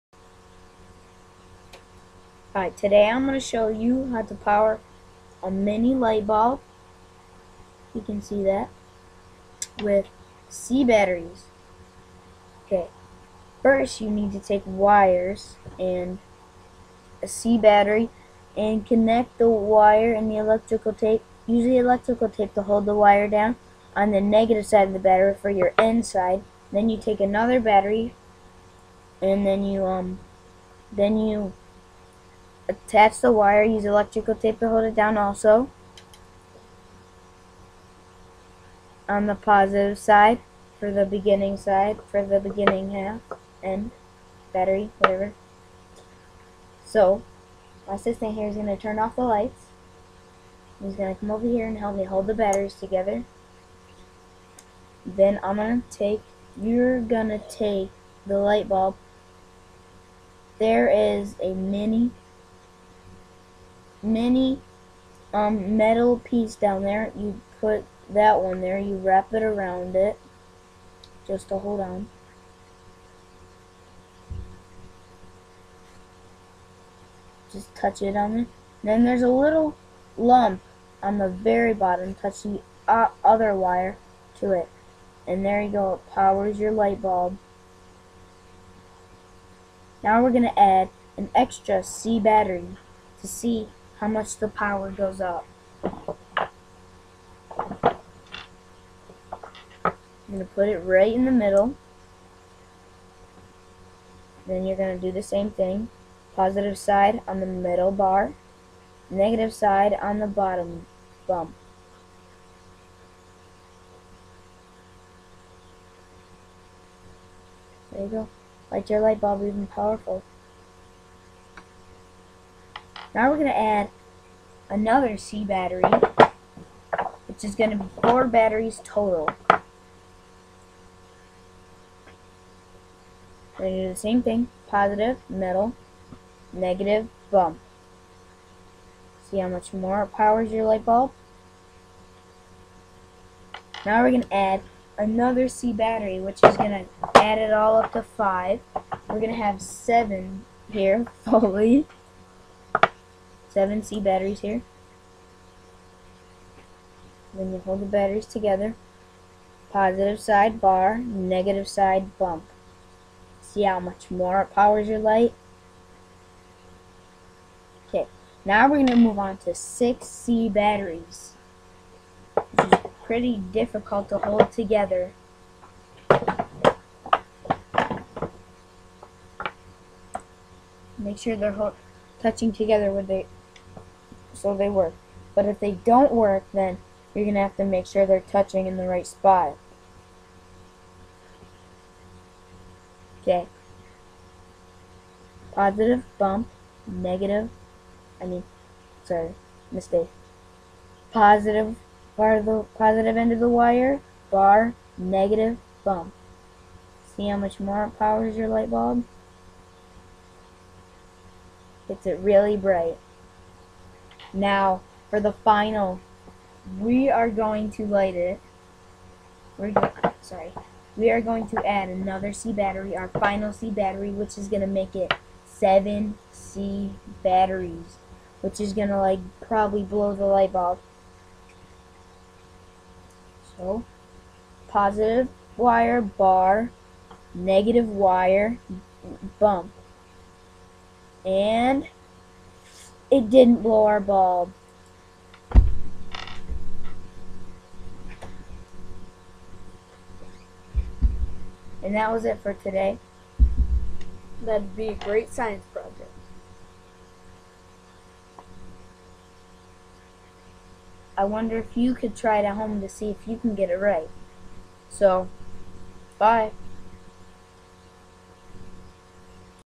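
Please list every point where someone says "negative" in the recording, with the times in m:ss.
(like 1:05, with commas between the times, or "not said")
0:24, 1:49, 2:16, 2:40, 3:16, 3:24, 3:57.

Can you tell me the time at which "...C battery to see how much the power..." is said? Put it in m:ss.
1:31.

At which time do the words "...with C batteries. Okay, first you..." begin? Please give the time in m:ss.
0:09.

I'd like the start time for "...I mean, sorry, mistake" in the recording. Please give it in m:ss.
3:18.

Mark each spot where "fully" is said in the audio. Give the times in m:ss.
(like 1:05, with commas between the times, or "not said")
2:31.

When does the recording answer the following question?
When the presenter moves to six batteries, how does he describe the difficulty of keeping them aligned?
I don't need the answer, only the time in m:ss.
2:53.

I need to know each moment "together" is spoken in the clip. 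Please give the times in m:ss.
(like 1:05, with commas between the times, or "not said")
0:52, 2:38, 2:54, 3:02.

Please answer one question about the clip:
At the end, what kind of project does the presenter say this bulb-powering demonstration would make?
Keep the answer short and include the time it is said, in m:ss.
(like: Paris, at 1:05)
science project, at 4:15.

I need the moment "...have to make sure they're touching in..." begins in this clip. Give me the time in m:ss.
3:07.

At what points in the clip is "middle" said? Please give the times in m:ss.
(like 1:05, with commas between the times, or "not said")
1:41, 1:47.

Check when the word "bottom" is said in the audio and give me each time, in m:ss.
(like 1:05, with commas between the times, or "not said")
1:21, 1:50.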